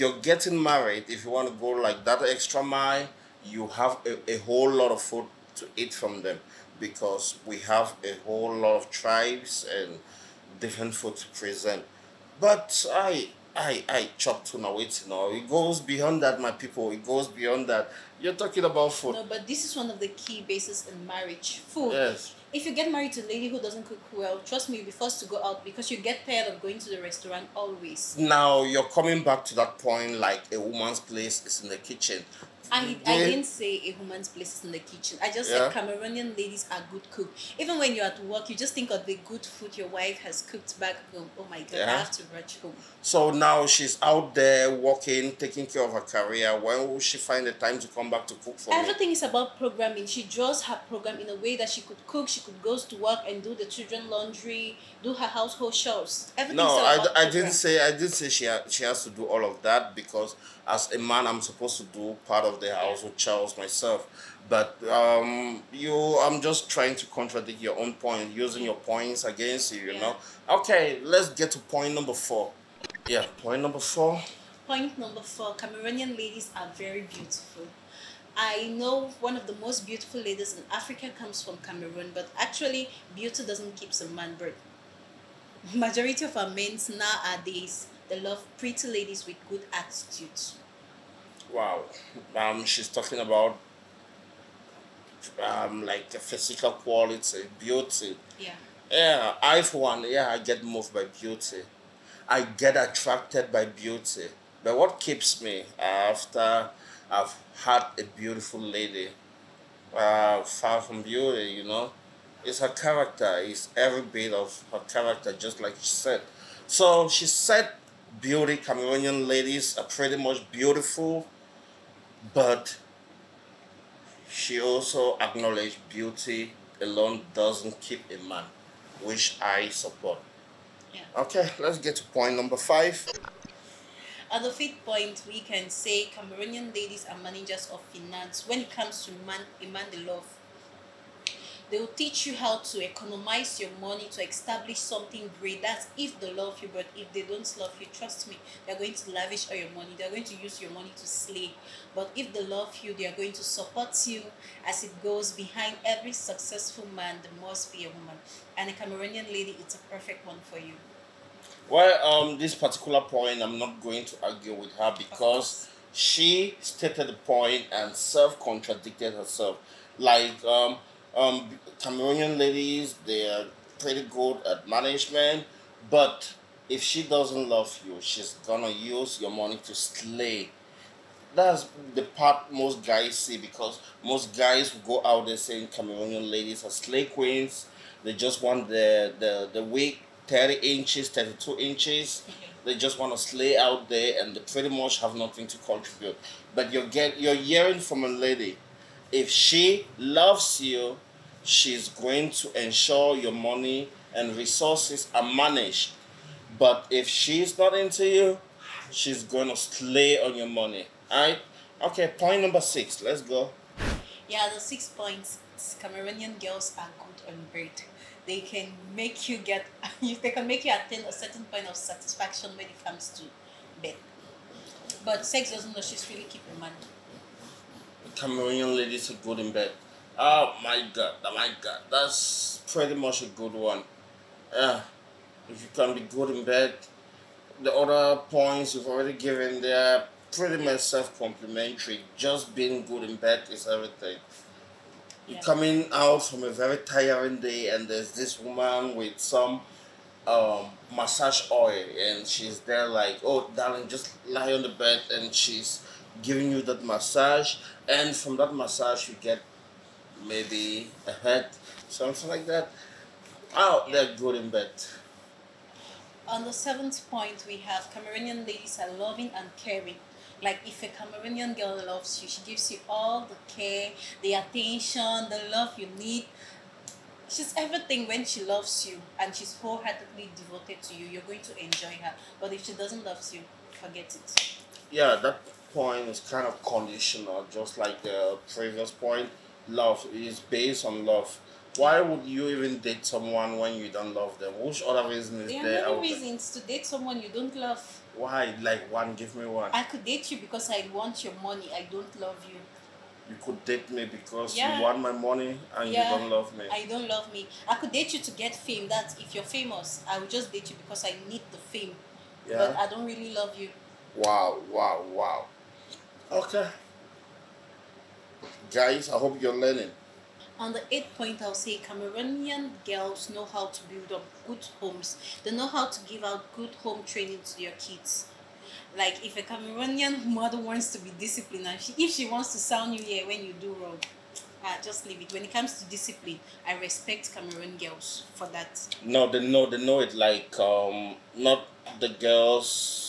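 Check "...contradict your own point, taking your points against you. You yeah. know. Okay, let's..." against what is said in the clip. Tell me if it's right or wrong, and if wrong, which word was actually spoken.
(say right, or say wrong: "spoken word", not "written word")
wrong: "using", not "taking".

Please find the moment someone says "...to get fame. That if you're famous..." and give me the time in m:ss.
5:08.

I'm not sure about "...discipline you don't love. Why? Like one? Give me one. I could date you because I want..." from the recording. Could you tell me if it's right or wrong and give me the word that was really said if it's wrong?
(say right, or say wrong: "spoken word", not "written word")
wrong: "someone", not "discipline".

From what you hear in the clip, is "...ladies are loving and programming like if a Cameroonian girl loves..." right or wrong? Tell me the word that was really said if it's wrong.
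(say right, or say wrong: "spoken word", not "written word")
wrong: "caring", not "programming".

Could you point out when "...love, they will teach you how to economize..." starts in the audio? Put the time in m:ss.
2:19.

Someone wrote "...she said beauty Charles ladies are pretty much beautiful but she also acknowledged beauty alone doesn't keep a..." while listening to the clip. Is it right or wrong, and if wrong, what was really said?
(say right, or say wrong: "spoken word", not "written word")
wrong: "Cameroonian", not "Charles".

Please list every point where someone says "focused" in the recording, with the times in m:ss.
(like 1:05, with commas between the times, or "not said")
not said.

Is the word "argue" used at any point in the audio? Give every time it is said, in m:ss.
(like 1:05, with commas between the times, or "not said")
2:44.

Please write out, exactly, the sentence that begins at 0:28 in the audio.
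Now you're coming back to that point like a woman's place is in the kitchen.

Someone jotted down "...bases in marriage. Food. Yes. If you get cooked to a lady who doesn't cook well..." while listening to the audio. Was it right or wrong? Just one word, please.
wrong.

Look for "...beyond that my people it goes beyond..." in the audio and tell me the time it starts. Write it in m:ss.
0:15.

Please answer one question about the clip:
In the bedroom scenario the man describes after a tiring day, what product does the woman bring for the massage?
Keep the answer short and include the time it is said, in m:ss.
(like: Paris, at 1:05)
massage oil, at 4:10.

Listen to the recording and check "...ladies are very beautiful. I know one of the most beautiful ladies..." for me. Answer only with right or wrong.
right.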